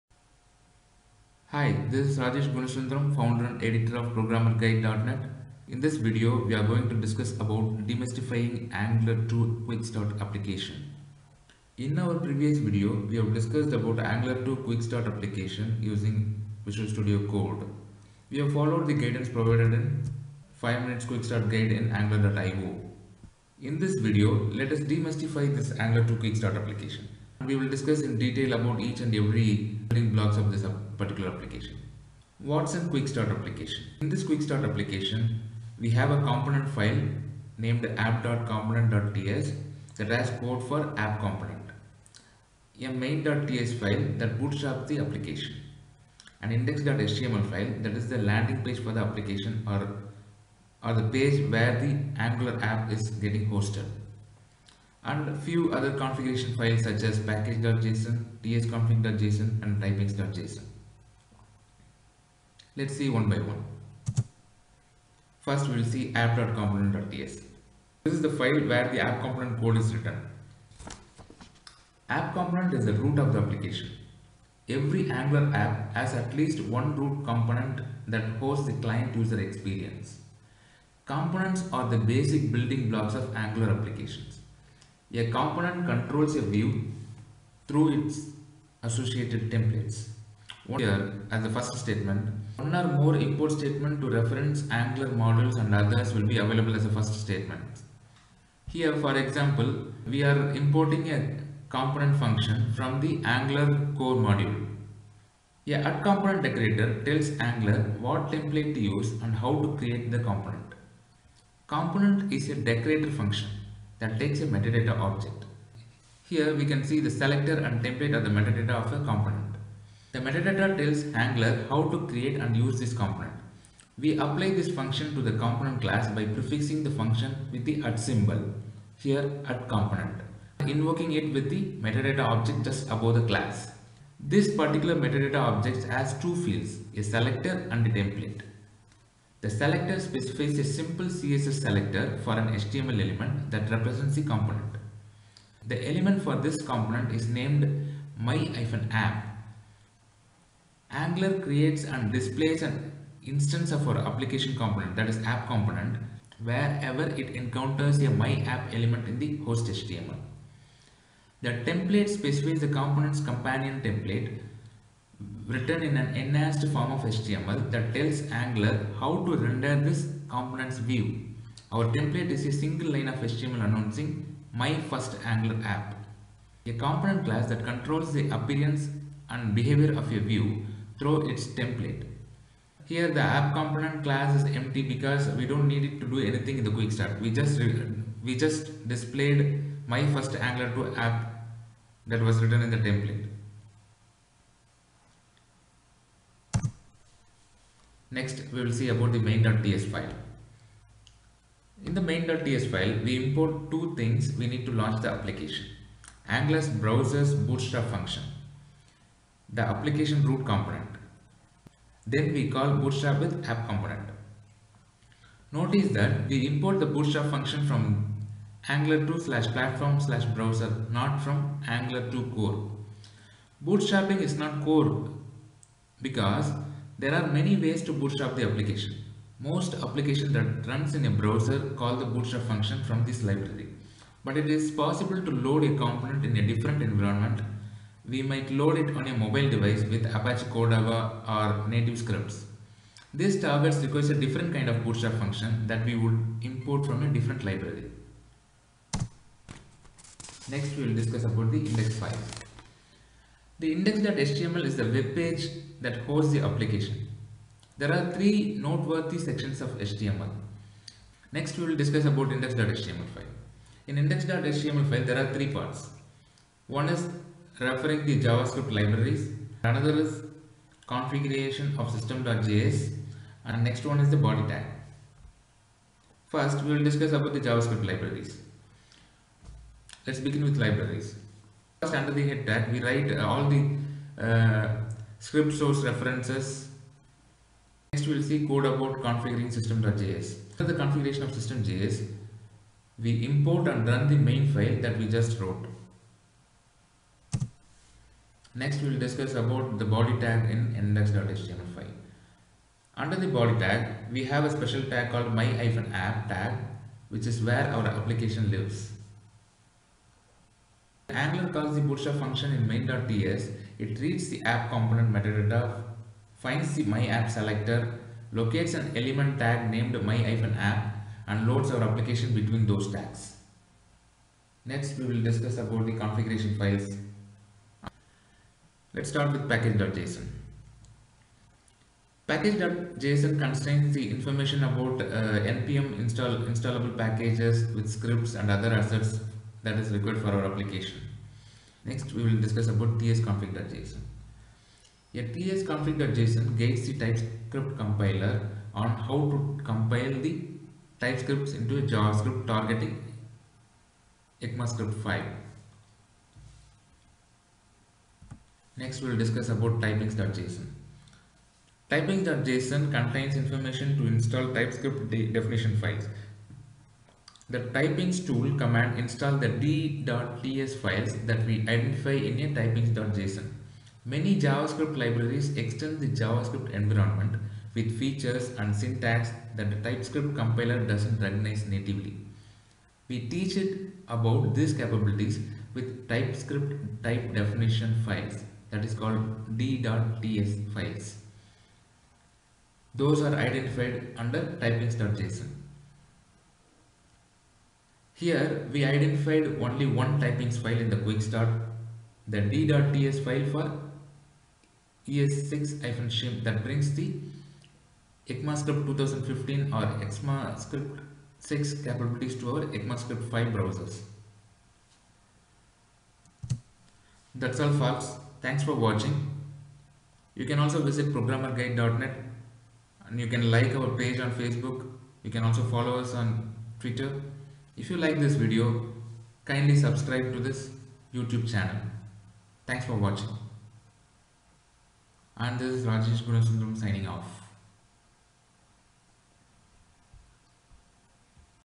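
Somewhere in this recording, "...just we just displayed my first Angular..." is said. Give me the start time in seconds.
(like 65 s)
187 s.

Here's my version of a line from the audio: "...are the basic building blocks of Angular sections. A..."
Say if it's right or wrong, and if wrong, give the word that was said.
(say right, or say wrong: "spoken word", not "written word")
wrong: "applications", not "sections".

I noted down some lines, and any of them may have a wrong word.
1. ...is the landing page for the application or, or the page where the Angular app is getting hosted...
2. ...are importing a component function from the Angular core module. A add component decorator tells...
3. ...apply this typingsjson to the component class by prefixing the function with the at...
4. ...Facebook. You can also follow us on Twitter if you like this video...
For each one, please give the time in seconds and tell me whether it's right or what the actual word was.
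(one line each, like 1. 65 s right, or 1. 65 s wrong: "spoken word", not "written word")
1. 47 s right
2. 100 s right
3. 124 s wrong: "function", not "typingsjson"
4. 424 s right.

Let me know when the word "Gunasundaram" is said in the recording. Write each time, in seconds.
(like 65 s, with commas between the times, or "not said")
2 s, 436 s.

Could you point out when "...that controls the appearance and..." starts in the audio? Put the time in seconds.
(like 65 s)
177 s.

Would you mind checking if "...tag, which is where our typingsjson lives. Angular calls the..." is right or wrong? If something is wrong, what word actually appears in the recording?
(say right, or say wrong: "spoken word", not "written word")
wrong: "application", not "typingsjson".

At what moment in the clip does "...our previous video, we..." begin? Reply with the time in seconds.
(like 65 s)
11 s.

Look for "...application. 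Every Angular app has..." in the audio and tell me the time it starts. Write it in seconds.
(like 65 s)
73 s.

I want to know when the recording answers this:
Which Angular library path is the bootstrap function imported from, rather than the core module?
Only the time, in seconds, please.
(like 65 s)
218 s.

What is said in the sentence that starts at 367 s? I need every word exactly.
The typings tool command install the d.ts files that we identify in a typings.json.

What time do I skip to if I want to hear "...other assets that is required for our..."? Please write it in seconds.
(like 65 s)
338 s.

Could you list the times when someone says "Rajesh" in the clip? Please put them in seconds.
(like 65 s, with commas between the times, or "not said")
2 s, 435 s.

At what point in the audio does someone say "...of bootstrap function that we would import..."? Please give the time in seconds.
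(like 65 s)
244 s.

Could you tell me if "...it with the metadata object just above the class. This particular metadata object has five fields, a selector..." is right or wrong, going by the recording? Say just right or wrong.
wrong.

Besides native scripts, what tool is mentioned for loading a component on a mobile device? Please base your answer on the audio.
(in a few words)
Apache Cordova.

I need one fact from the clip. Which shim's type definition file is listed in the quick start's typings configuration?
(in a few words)
ES6-shim.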